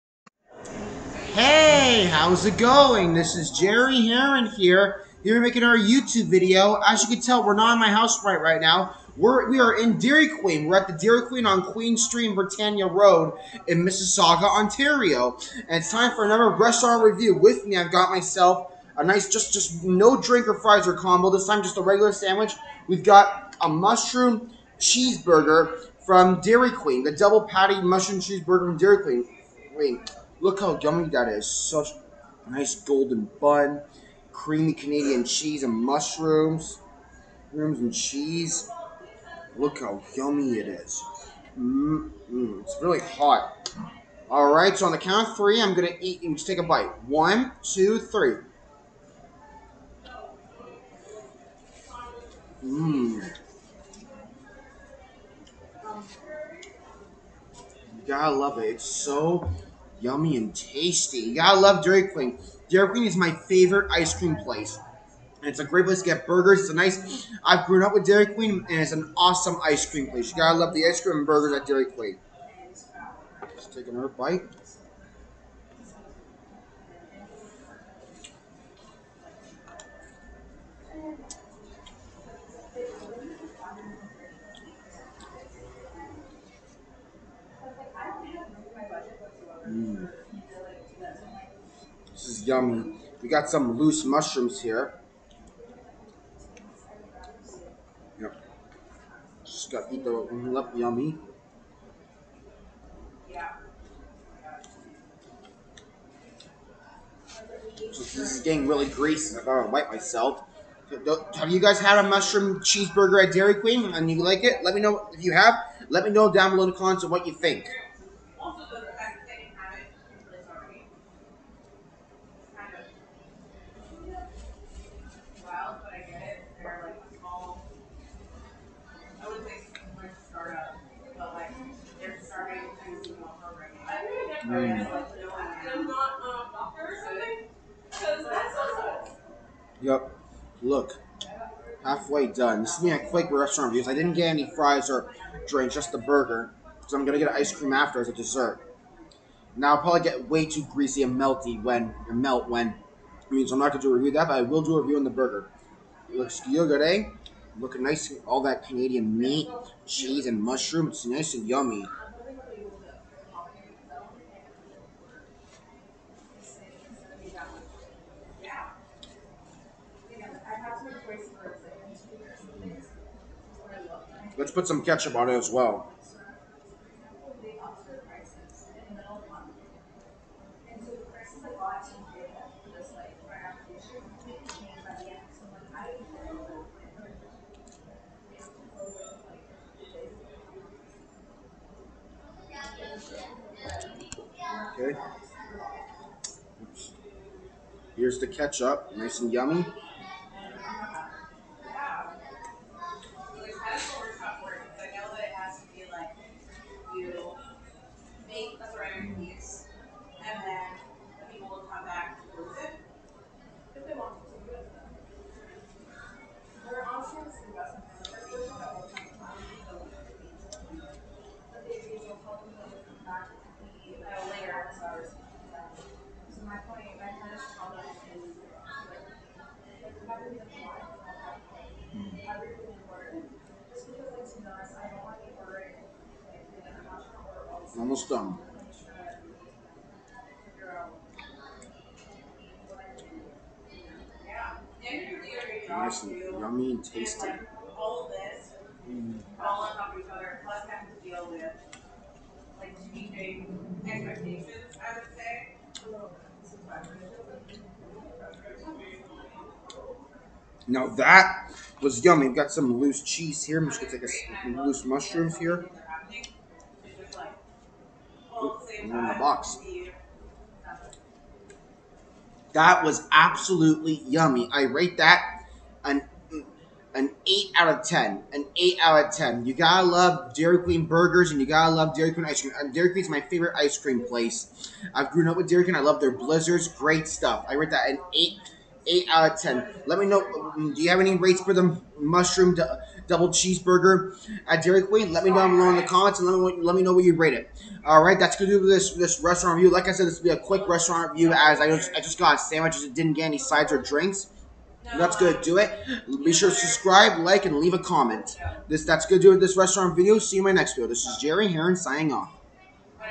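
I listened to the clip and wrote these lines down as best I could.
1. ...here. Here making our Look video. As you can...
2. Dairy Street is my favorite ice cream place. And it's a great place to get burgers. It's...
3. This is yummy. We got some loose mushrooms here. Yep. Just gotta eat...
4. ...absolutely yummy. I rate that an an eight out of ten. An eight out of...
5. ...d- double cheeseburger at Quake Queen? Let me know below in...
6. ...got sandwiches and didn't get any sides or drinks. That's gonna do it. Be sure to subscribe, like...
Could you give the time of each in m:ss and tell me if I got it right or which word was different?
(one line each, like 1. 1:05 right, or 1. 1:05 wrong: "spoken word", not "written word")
1. 0:04 wrong: "YouTube", not "Look"
2. 1:02 wrong: "Queen", not "Street"
3. 1:32 right
4. 4:33 right
5. 4:52 wrong: "Dairy", not "Quake"
6. 5:02 right.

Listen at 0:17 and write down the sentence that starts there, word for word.
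With me, I've got myself a nice, just, just no drink or fries or combo.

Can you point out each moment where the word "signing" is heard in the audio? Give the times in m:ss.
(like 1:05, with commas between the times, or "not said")
5:11.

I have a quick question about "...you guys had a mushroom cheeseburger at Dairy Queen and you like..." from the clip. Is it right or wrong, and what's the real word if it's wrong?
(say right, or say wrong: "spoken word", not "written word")
right.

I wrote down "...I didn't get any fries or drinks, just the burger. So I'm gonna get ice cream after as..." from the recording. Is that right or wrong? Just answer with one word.
right.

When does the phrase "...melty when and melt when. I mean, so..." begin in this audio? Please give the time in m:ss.
2:31.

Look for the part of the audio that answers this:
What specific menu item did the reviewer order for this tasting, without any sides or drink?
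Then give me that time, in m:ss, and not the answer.
0:27.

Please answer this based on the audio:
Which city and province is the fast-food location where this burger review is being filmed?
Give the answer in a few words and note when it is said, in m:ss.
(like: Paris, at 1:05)
Mississauga, Ontario, at 0:13.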